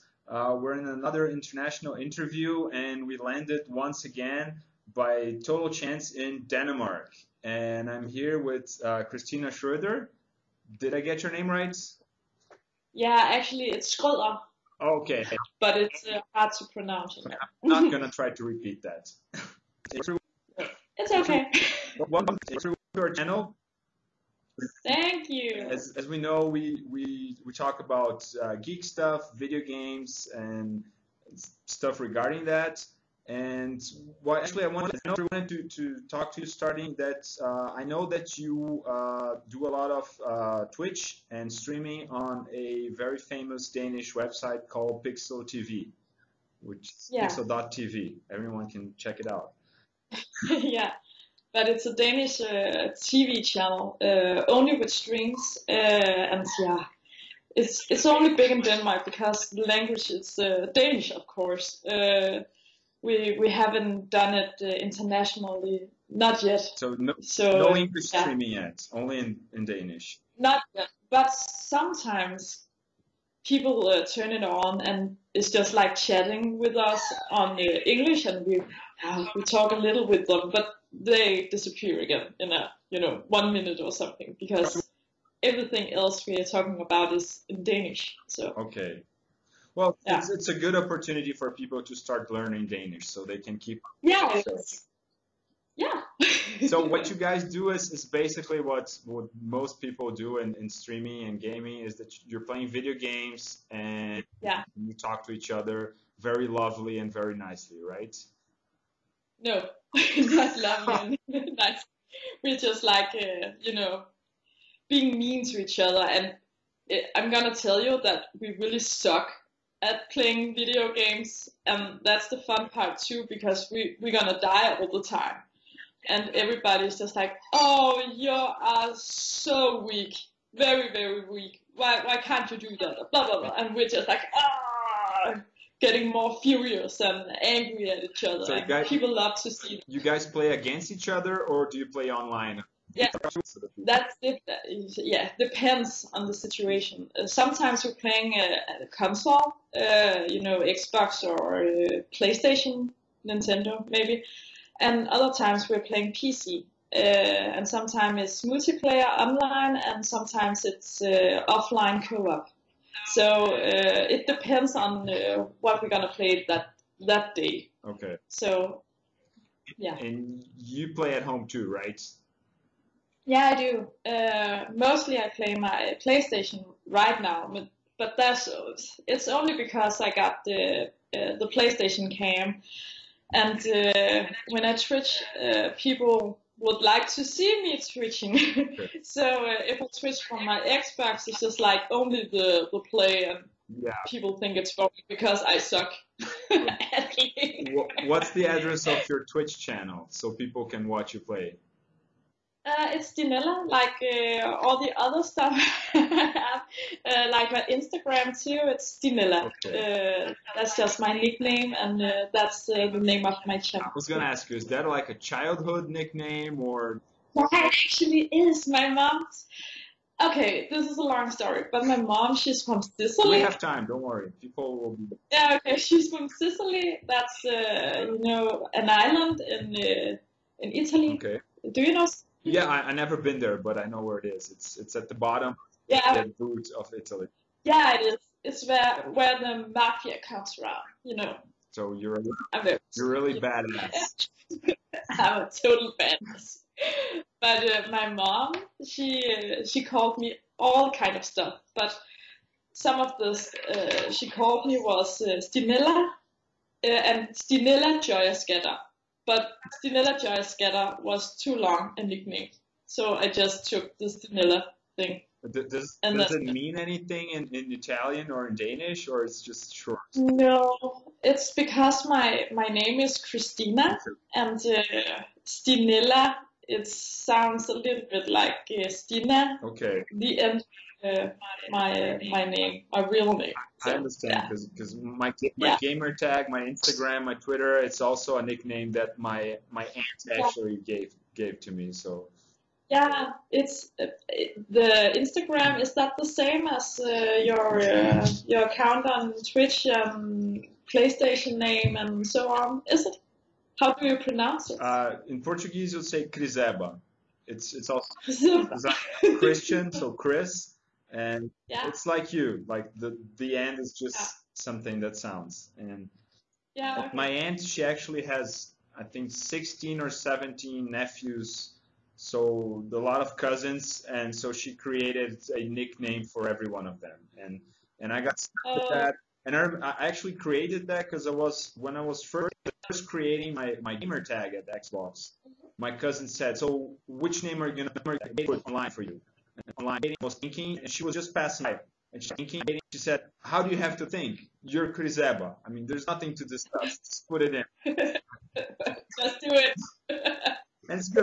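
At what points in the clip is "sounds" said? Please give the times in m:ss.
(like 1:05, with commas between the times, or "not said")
4:36, 5:15.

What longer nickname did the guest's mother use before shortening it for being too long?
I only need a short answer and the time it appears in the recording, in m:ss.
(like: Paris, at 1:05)
Stinella Joy Scatter, at 4:19.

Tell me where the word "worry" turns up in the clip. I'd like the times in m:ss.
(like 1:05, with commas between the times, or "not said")
3:44.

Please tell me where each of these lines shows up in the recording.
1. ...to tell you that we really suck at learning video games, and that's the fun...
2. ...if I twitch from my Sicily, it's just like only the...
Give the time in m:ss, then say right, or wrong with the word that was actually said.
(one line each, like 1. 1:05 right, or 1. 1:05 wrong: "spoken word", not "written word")
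1. 1:57 wrong: "playing", not "learning"
2. 3:09 wrong: "Xbox", not "Sicily".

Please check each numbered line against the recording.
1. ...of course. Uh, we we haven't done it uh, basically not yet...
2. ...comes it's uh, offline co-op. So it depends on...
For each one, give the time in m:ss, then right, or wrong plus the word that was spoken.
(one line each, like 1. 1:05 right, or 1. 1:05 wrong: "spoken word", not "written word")
1. 1:01 wrong: "internationally", not "basically"
2. 2:40 wrong: "sometimes", not "comes".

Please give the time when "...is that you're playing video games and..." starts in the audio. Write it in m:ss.
1:41.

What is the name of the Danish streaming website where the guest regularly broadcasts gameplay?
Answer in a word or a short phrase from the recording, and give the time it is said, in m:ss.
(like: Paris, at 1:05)
Pixel TV, at 0:45.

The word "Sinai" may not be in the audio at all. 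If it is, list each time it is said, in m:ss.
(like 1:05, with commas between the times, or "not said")
not said.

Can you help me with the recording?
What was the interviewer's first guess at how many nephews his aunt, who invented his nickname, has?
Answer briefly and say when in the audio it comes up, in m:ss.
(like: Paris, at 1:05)
16, at 5:19.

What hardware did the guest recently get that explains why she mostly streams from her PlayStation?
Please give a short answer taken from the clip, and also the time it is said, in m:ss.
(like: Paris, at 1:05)
PlayStation cam, at 3:01.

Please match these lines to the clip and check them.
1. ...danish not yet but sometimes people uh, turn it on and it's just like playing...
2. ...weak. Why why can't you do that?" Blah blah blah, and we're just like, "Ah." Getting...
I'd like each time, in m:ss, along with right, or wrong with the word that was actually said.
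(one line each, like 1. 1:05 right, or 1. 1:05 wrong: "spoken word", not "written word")
1. 1:09 wrong: "chatting", not "playing"
2. 2:11 right.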